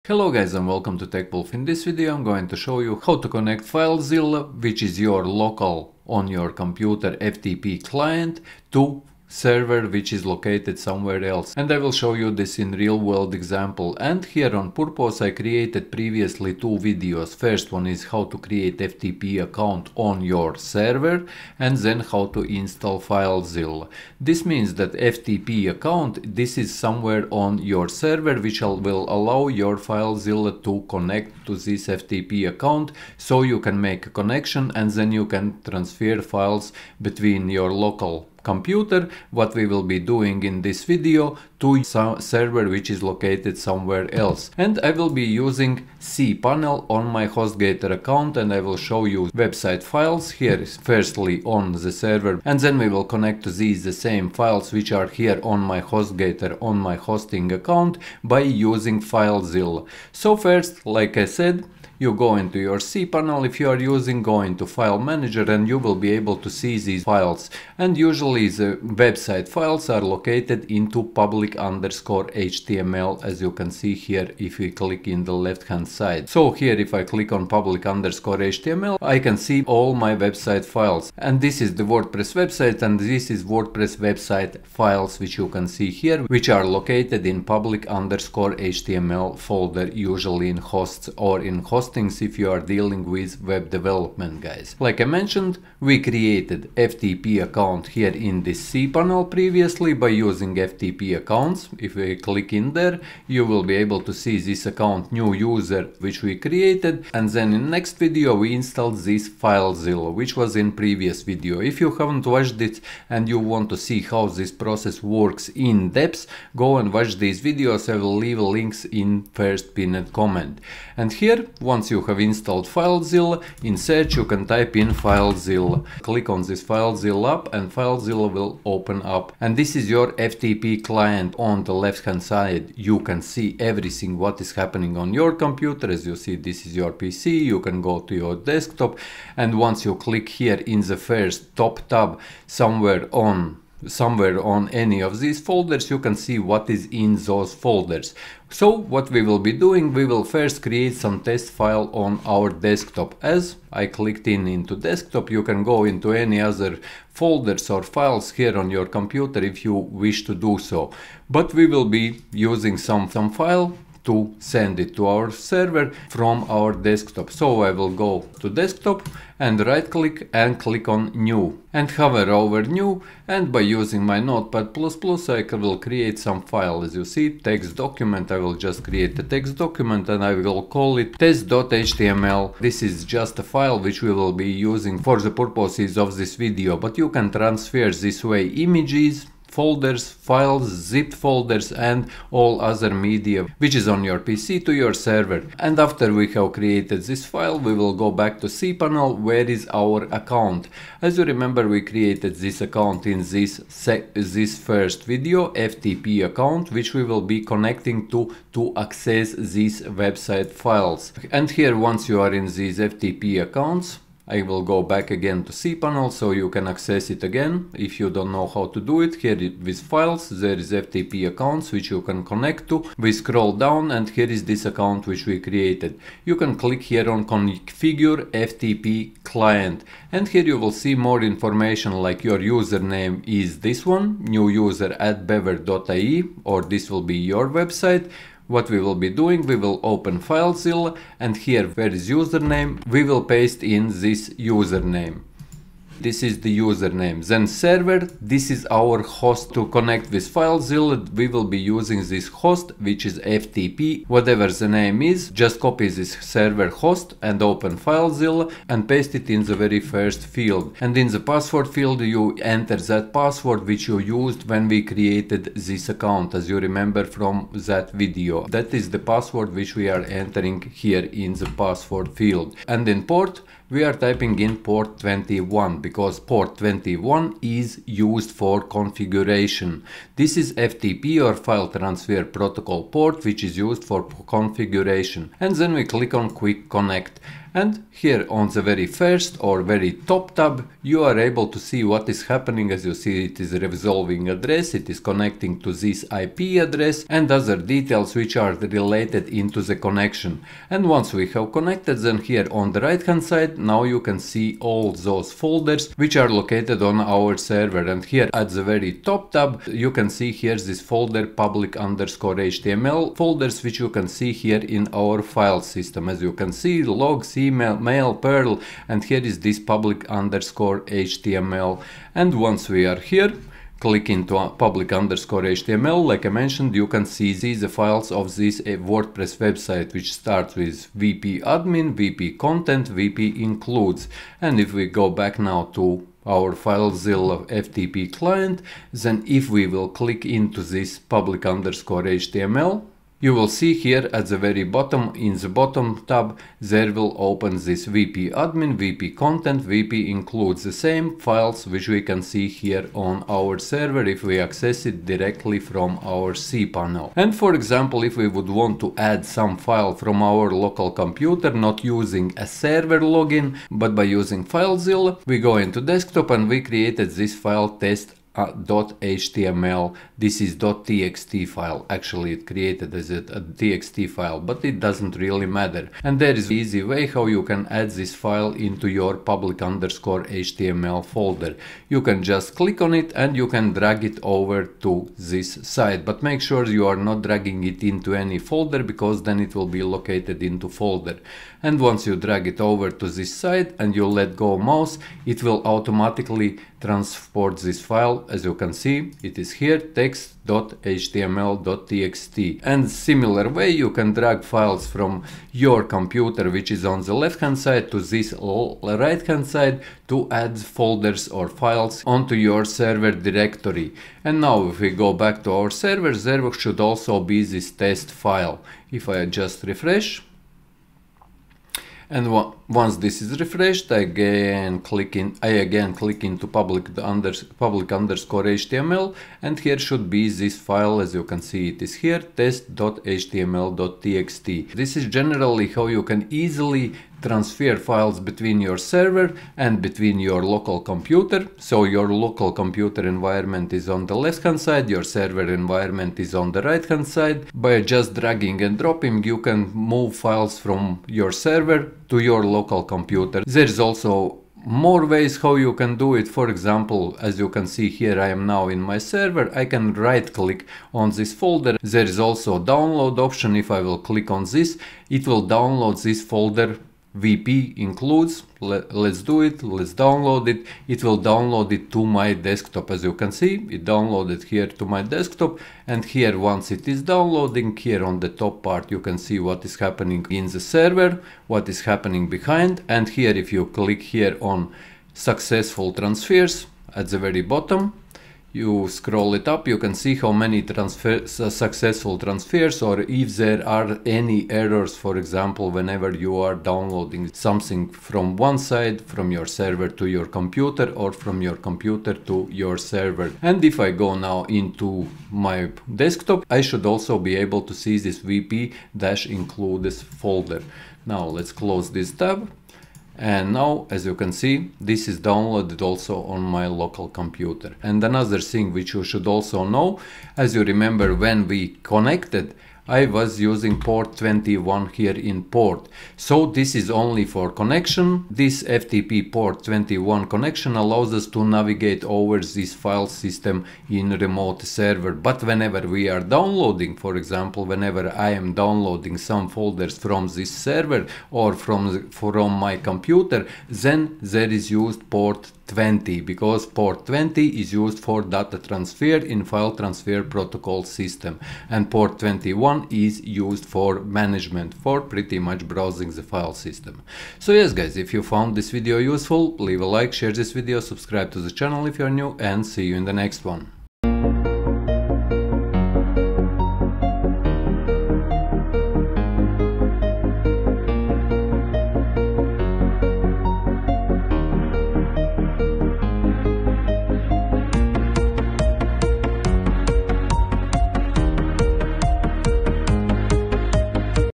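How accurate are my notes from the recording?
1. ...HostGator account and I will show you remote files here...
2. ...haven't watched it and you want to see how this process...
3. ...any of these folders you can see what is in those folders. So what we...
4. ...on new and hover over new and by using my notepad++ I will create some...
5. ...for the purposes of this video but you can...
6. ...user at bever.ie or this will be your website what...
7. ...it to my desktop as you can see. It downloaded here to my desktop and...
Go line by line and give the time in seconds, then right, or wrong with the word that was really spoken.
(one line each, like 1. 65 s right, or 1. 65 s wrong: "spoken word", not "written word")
1. 47 s wrong: "website", not "remote"
2. 111 s right
3. 144 s right
4. 170 s right
5. 184 s right
6. 234 s right
7. 471 s right.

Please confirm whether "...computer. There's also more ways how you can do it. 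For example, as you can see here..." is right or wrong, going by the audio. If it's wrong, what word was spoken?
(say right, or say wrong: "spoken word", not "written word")
right.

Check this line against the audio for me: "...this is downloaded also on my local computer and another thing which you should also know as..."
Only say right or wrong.
right.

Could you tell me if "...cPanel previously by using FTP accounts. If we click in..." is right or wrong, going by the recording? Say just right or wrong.
right.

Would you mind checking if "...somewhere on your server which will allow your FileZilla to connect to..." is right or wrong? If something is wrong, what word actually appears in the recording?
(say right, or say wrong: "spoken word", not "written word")
right.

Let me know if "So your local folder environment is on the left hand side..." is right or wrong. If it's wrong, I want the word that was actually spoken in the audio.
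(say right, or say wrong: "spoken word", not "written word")
wrong: "computer", not "folder".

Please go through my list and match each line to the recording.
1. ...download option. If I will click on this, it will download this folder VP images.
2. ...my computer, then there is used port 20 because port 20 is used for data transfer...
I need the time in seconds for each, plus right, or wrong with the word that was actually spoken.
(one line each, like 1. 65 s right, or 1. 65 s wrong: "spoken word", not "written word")
1. 462 s wrong: "includes", not "images"
2. 542 s right.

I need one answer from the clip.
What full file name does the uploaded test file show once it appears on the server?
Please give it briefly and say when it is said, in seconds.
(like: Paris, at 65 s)
test.html.txt, at 432 s.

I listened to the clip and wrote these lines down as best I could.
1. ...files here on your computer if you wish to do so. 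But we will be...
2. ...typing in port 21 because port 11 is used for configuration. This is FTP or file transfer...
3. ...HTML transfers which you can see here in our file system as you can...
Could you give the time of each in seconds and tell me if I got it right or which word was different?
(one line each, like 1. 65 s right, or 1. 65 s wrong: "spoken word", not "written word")
1. 157 s right
2. 273 s wrong: "21", not "11"
3. 312 s wrong: "folders", not "transfers".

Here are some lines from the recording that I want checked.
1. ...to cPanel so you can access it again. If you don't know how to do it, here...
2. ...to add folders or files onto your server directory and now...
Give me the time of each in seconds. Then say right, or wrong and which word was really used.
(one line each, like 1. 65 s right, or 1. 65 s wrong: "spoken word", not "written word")
1. 215 s right
2. 410 s right.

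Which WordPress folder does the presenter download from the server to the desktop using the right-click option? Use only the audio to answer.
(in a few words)
vp-includes.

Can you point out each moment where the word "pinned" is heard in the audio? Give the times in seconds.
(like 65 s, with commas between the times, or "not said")
119 s.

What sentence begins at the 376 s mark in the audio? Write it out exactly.
And there is easy way how you can add this file into your public underscore HTML folder.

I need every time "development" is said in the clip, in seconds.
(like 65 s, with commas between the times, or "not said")
93 s.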